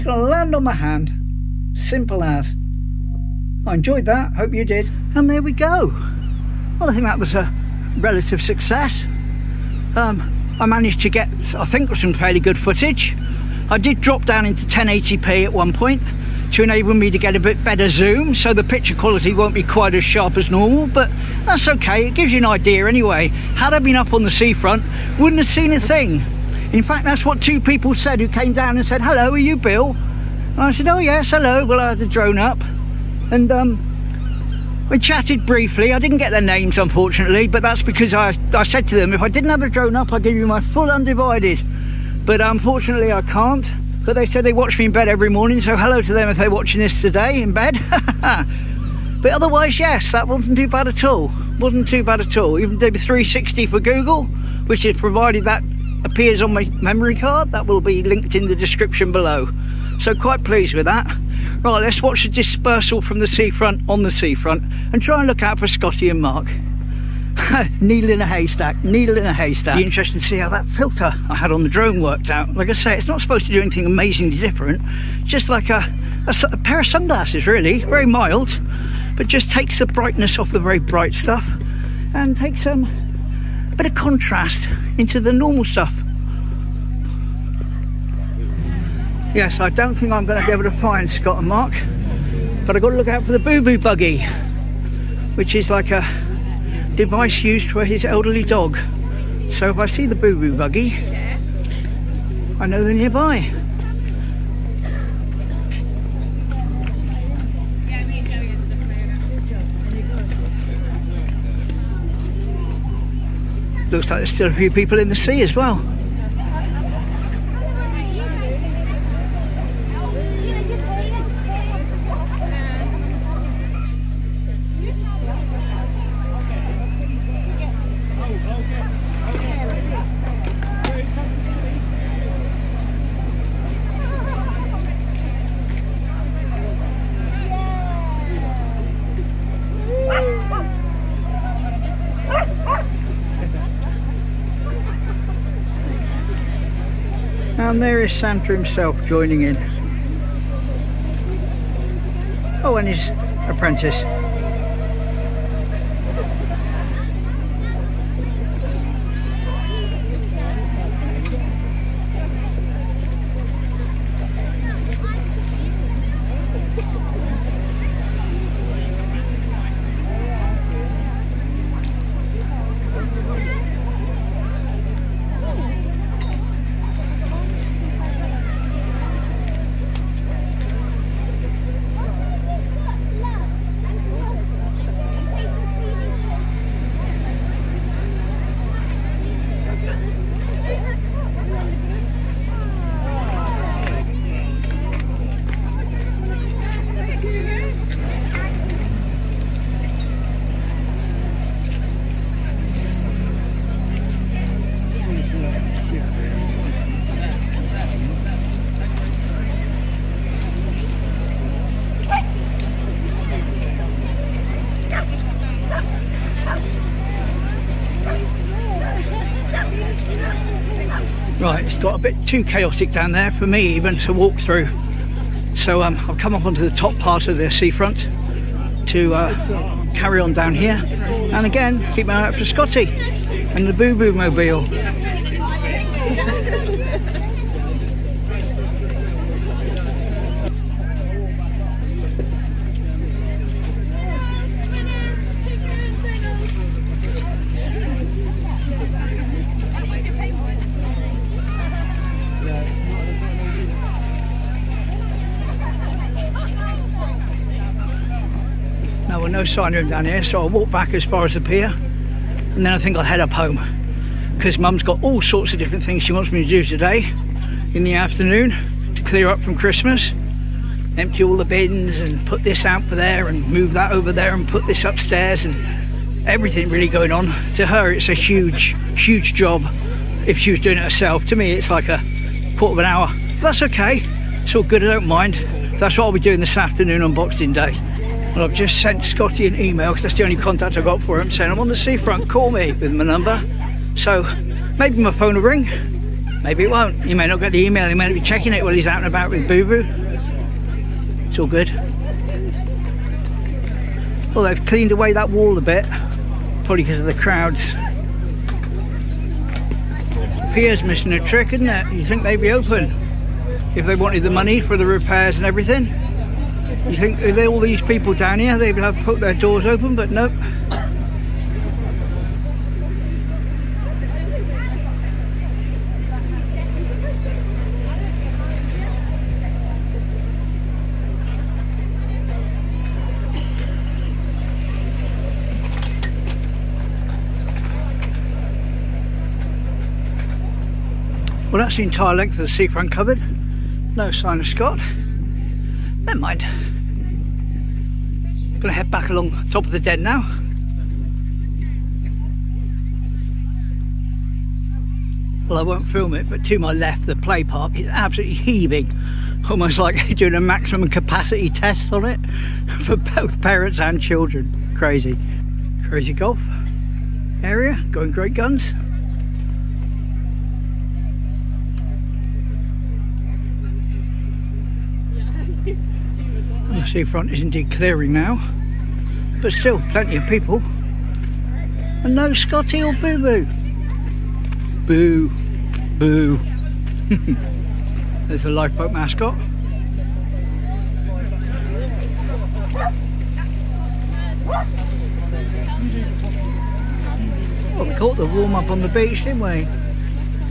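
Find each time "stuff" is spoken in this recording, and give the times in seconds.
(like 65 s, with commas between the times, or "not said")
81 s, 85 s.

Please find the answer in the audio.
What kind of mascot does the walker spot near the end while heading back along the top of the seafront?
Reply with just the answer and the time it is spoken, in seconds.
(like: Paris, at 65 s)
lifeboat mascot, at 388 s.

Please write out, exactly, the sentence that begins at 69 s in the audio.
Be interesting to see how that filter I had on the drone worked out.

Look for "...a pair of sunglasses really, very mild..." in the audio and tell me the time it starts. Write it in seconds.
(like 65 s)
76 s.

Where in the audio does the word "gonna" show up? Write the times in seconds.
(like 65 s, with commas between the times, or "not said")
348 s.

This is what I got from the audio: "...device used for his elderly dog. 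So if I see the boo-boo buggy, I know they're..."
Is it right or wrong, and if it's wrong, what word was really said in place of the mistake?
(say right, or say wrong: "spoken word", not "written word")
right.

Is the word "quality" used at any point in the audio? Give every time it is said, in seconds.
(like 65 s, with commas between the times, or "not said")
18 s.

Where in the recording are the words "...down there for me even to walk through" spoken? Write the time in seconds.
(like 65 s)
222 s.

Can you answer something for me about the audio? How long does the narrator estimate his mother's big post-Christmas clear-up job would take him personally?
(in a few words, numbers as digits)
a quarter of an hour.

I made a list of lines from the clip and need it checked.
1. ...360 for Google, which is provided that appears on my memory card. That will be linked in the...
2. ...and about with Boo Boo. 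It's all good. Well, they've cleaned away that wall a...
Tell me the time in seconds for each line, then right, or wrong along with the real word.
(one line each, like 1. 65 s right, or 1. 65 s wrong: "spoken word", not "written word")
1. 52 s right
2. 298 s right.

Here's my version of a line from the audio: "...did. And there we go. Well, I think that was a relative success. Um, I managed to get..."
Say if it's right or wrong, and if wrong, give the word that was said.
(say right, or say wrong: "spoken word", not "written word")
right.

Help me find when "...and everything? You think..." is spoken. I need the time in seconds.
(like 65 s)
315 s.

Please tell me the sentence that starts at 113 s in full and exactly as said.
Looks like there's still a few people in the sea as well.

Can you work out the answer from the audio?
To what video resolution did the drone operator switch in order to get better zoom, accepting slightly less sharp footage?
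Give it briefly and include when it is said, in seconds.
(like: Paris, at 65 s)
1080p, at 14 s.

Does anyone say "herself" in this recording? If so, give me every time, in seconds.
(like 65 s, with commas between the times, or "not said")
280 s.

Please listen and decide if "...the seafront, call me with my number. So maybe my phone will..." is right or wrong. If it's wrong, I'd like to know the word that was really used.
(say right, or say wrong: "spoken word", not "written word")
right.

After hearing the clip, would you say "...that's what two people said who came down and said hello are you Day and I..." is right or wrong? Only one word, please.
wrong.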